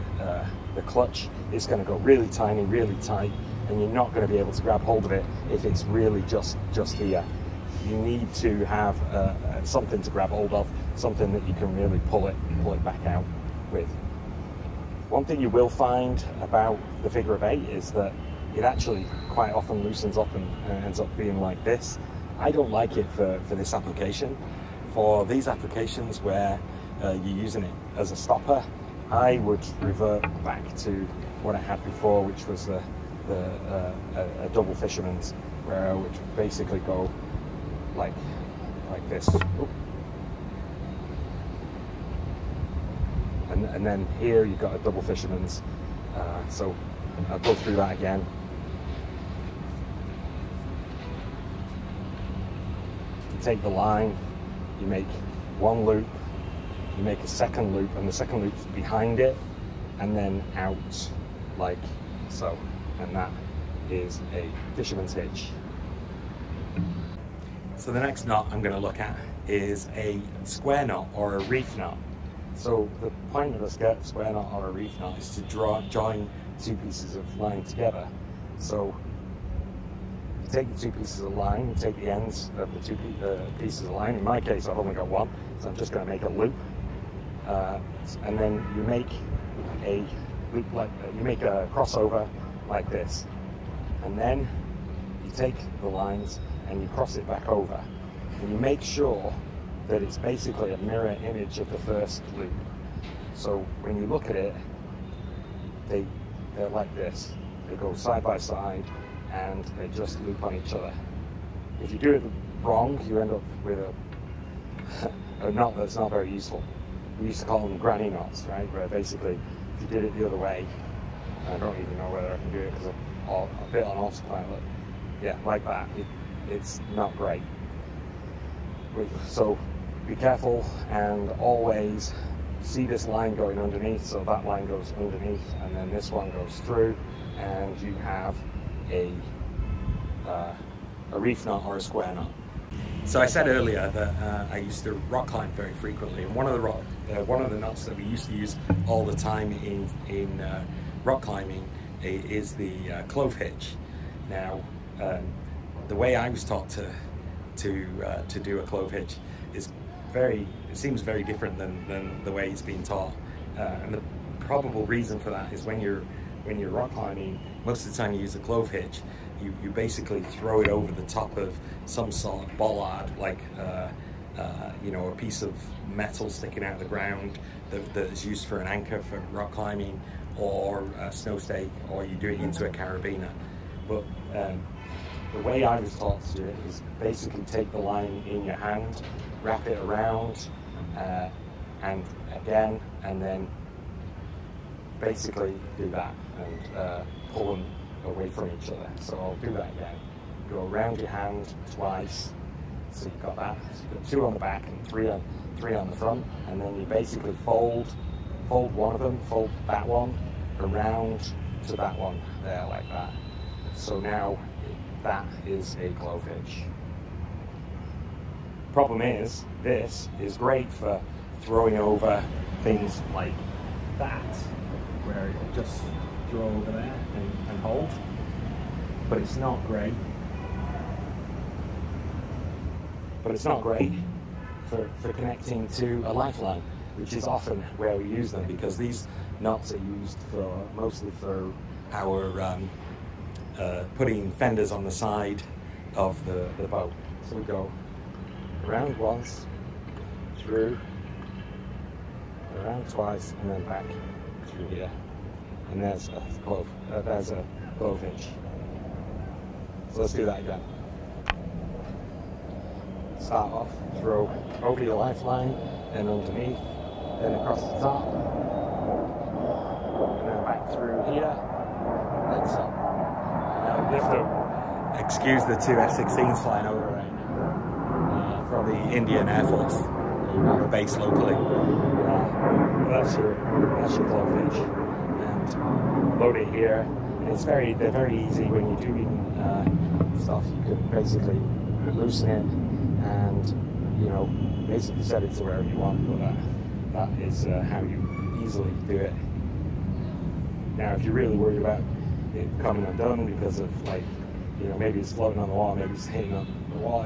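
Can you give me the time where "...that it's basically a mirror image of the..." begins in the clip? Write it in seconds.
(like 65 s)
99 s.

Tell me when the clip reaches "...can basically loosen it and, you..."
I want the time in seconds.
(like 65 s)
290 s.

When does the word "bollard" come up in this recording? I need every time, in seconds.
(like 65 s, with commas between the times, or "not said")
172 s.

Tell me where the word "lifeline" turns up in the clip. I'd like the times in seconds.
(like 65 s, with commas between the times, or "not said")
236 s, 264 s.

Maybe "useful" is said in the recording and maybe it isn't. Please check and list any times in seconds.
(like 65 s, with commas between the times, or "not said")
116 s.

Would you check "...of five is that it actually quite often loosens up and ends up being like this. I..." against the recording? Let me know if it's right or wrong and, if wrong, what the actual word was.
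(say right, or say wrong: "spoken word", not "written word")
wrong: "eight", not "five".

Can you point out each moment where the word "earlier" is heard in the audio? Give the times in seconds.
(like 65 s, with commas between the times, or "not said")
143 s.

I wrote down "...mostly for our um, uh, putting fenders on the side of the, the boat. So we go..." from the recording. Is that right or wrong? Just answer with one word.
right.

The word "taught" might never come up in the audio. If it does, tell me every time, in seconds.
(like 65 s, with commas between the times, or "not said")
156 s, 162 s, 185 s.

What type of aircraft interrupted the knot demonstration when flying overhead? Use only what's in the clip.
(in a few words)
F-16s.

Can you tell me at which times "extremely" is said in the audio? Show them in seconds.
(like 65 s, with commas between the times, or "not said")
not said.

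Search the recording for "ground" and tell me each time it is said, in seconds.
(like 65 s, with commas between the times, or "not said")
176 s.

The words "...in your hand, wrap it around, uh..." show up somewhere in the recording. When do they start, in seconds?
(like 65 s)
188 s.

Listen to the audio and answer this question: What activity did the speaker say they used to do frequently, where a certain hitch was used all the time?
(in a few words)
Rock climb.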